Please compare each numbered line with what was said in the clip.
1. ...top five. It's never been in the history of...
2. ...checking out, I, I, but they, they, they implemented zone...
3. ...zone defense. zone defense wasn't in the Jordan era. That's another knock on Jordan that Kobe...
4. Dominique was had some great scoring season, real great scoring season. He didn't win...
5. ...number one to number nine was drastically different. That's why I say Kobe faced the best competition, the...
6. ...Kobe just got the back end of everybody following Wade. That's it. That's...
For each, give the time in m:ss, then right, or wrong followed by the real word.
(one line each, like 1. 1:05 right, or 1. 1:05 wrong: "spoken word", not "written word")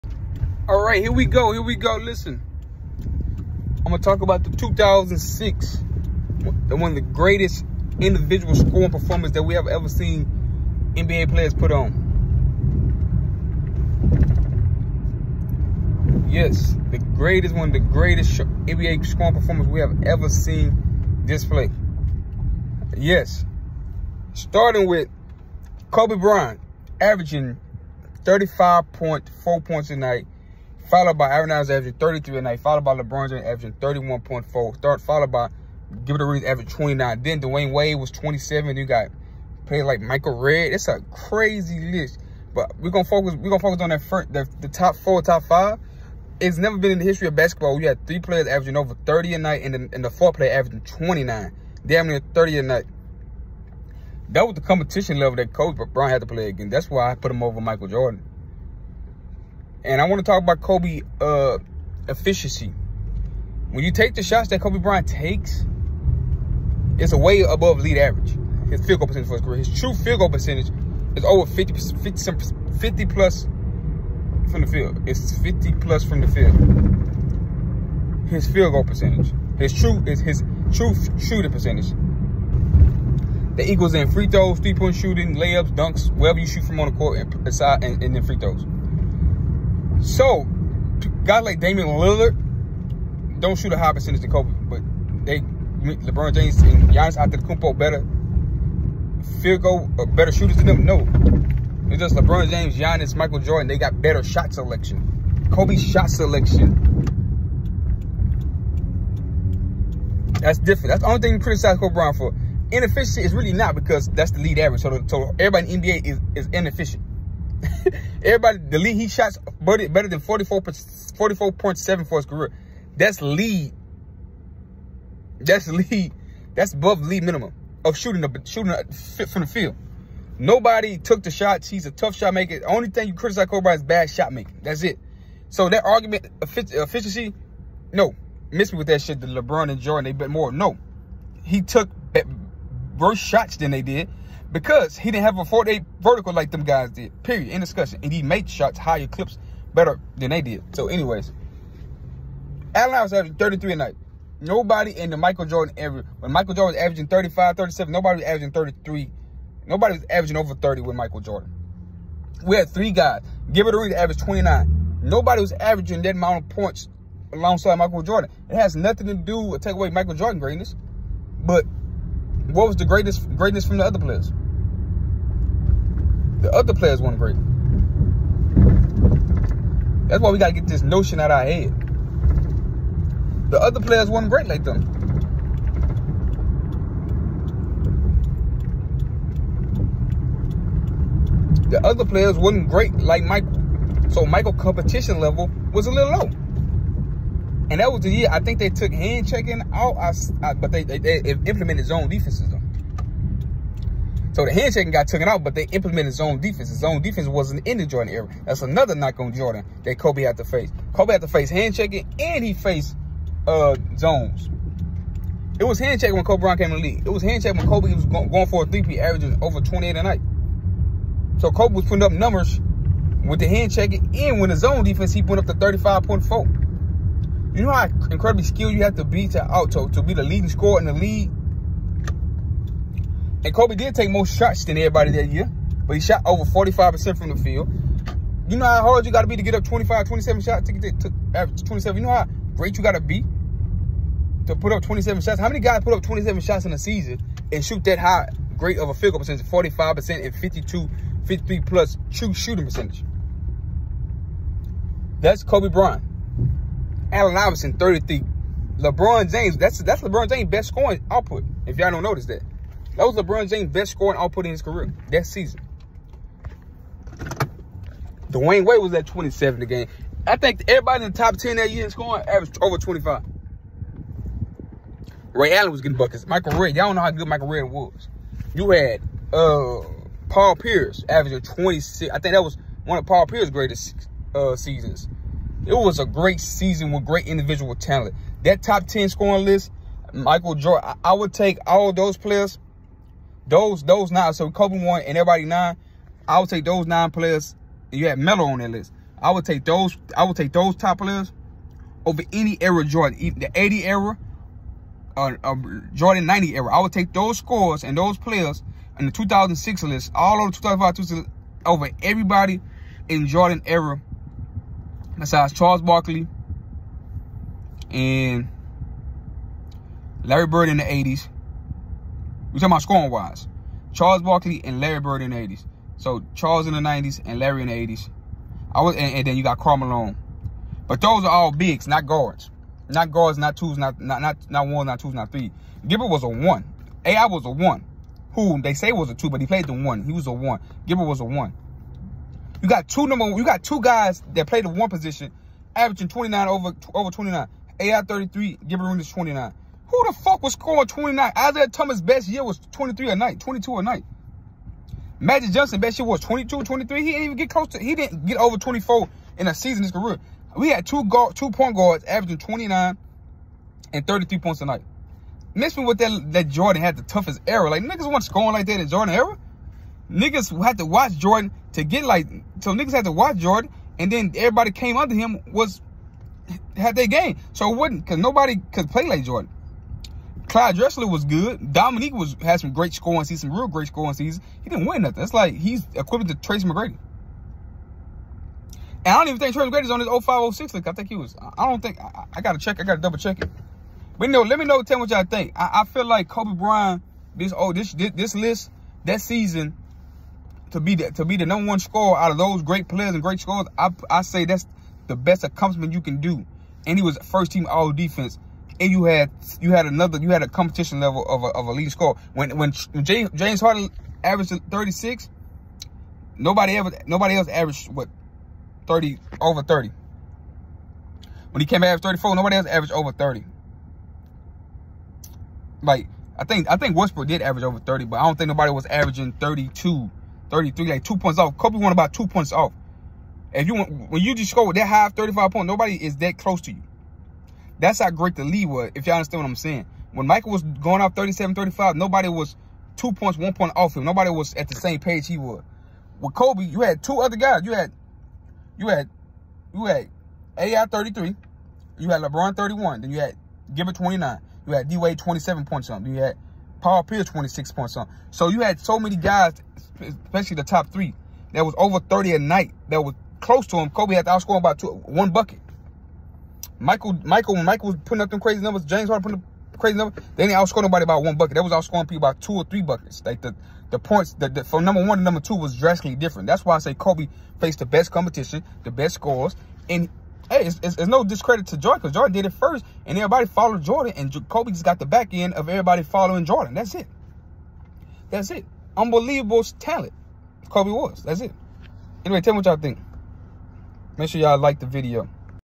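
1. 0:45 right
2. 3:19 right
3. 3:26 right
4. 6:21 right
5. 7:54 wrong: "two", not "nine"
6. 8:04 wrong: "Jordan", not "Wade".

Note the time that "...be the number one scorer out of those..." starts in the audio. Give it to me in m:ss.
6:41.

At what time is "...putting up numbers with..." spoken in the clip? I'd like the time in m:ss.
3:41.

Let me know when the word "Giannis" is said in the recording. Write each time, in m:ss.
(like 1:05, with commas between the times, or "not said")
1:36, 1:42.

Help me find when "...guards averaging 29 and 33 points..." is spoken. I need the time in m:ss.
6:01.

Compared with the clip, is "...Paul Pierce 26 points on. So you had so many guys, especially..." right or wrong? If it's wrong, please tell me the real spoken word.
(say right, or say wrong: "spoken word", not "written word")
right.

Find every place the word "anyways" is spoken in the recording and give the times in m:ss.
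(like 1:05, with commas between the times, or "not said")
2:30, 8:12.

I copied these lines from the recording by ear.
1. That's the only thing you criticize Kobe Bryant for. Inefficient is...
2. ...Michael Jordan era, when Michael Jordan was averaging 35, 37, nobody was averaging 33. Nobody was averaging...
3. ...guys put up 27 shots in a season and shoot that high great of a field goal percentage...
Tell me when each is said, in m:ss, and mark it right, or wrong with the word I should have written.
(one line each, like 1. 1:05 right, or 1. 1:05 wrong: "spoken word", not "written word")
1. 1:50 right
2. 2:35 right
3. 4:05 right.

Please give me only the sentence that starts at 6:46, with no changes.
And he was first team all defense.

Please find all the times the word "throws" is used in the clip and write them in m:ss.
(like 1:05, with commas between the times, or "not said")
1:24, 1:28.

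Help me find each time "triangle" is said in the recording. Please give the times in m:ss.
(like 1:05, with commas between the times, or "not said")
not said.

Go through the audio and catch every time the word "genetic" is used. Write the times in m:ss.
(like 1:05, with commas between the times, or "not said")
not said.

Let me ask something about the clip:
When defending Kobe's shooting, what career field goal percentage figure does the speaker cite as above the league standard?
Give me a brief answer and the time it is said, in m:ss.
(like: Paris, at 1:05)
44.7, at 2:00.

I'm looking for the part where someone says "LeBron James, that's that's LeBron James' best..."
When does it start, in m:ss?
4:18.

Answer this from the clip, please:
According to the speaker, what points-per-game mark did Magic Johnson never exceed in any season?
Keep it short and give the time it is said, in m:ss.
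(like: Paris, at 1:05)
24, at 5:57.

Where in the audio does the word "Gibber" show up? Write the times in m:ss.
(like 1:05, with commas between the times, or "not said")
5:35, 5:40, 5:48, 7:33.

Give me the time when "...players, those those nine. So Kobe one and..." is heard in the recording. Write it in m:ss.
4:52.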